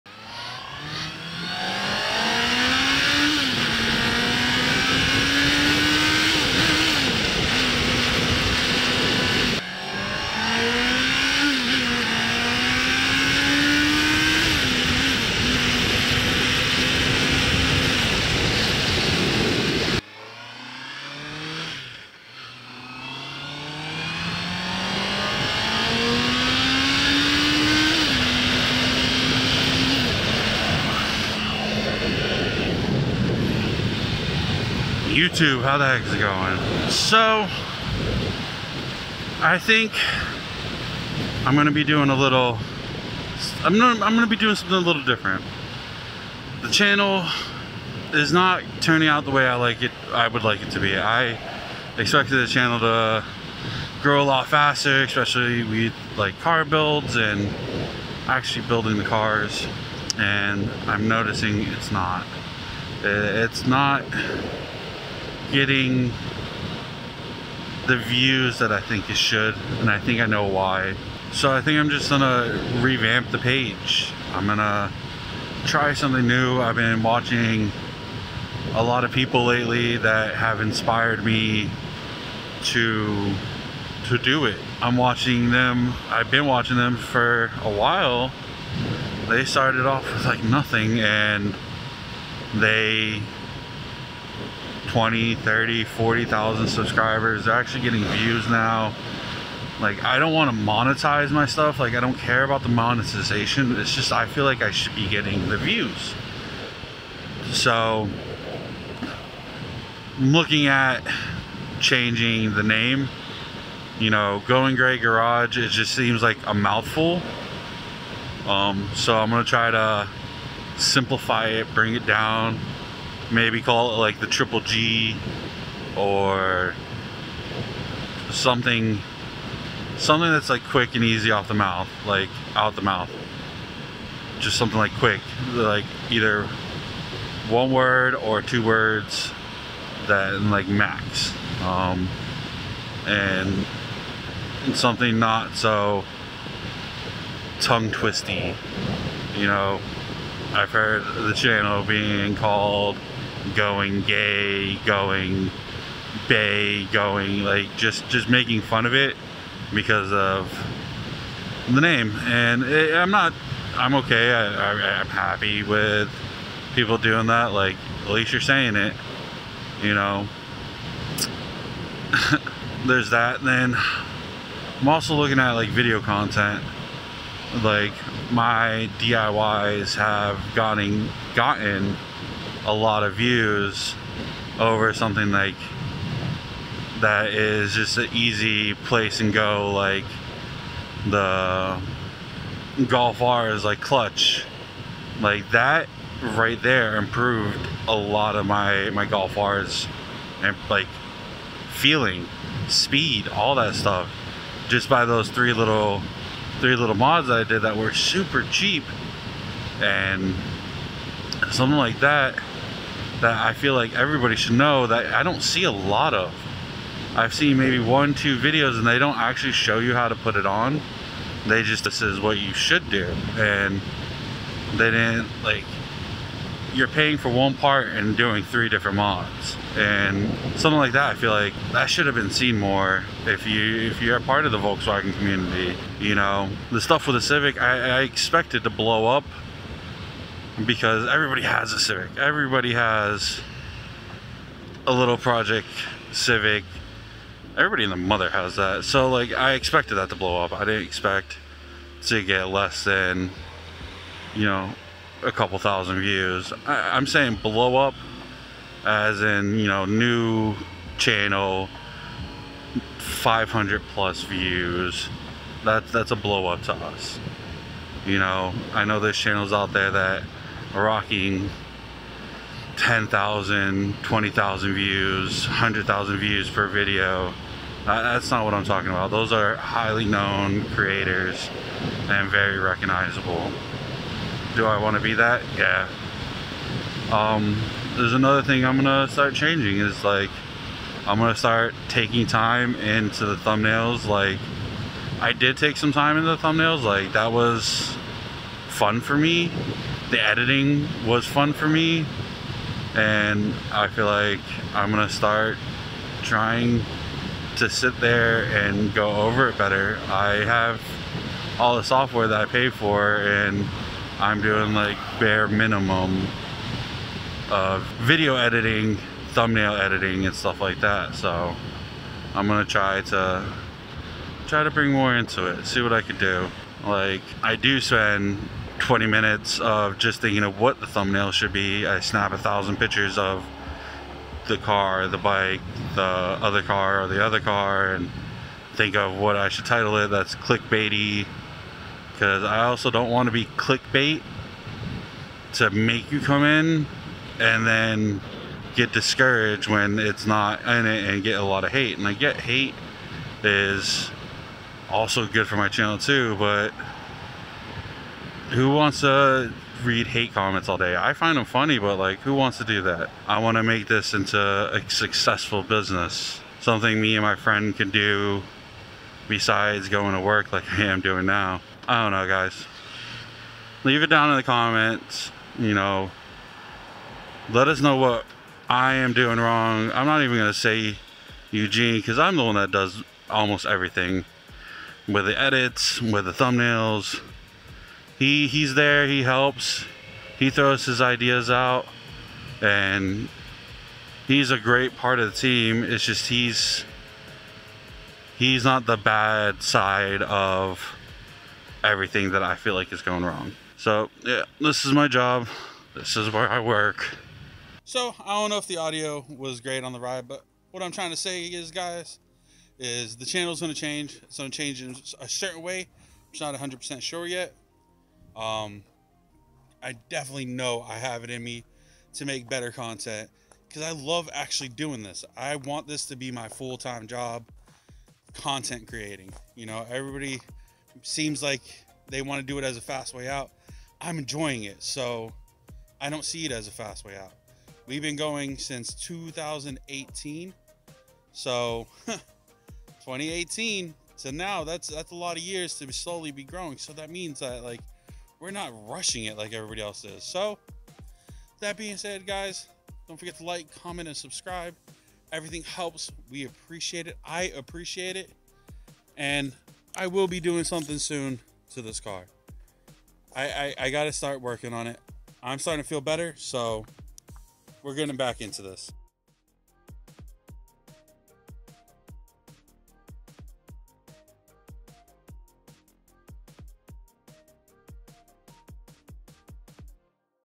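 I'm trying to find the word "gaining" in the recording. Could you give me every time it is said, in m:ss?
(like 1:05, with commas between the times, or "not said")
not said.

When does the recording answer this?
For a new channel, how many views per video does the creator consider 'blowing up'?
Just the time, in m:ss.
4:22.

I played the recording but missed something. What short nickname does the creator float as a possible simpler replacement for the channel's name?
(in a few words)
the triple G.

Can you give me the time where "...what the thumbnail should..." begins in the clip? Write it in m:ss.
5:30.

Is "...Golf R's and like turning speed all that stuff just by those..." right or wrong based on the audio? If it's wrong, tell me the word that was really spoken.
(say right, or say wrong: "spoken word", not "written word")
wrong: "feeling", not "turning".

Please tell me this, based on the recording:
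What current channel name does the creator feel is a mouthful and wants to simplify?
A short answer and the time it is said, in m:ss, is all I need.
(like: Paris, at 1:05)
Going Gray Garage, at 1:54.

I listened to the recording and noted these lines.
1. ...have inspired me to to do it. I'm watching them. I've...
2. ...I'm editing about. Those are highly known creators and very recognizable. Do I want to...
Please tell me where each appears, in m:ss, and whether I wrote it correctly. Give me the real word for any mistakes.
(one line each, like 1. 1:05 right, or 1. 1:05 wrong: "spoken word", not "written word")
1. 1:20 right
2. 4:38 wrong: "talking", not "editing".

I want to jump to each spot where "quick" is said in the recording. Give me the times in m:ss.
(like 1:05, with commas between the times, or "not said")
2:10, 2:14.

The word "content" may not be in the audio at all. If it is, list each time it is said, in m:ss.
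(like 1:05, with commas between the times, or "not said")
2:56, 7:02, 7:08.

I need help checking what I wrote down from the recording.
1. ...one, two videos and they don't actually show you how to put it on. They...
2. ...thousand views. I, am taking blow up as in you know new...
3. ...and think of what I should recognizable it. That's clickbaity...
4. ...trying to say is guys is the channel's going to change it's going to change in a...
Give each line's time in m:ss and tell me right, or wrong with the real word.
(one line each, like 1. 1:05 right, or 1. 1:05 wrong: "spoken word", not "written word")
1. 3:37 right
2. 4:15 wrong: "saying", not "taking"
3. 5:37 wrong: "title", not "recognizable"
4. 6:50 right.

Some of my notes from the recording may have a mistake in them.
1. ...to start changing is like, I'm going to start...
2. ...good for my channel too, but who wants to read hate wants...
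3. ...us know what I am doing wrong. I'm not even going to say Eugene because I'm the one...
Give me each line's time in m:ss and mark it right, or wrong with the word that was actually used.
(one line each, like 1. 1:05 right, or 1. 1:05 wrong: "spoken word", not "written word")
1. 4:49 right
2. 5:55 wrong: "comments", not "wants"
3. 6:17 right.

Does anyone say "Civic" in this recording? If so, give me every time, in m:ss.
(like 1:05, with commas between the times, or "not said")
3:57, 4:01, 4:06.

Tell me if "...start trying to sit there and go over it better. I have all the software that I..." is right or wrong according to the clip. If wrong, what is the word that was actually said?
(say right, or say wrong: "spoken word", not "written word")
right.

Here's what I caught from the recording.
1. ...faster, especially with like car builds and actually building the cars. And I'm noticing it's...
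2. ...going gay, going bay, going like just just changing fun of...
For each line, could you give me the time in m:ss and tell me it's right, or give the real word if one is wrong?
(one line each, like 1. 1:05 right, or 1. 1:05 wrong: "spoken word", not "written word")
1. 0:54 right
2. 2:33 wrong: "making", not "changing".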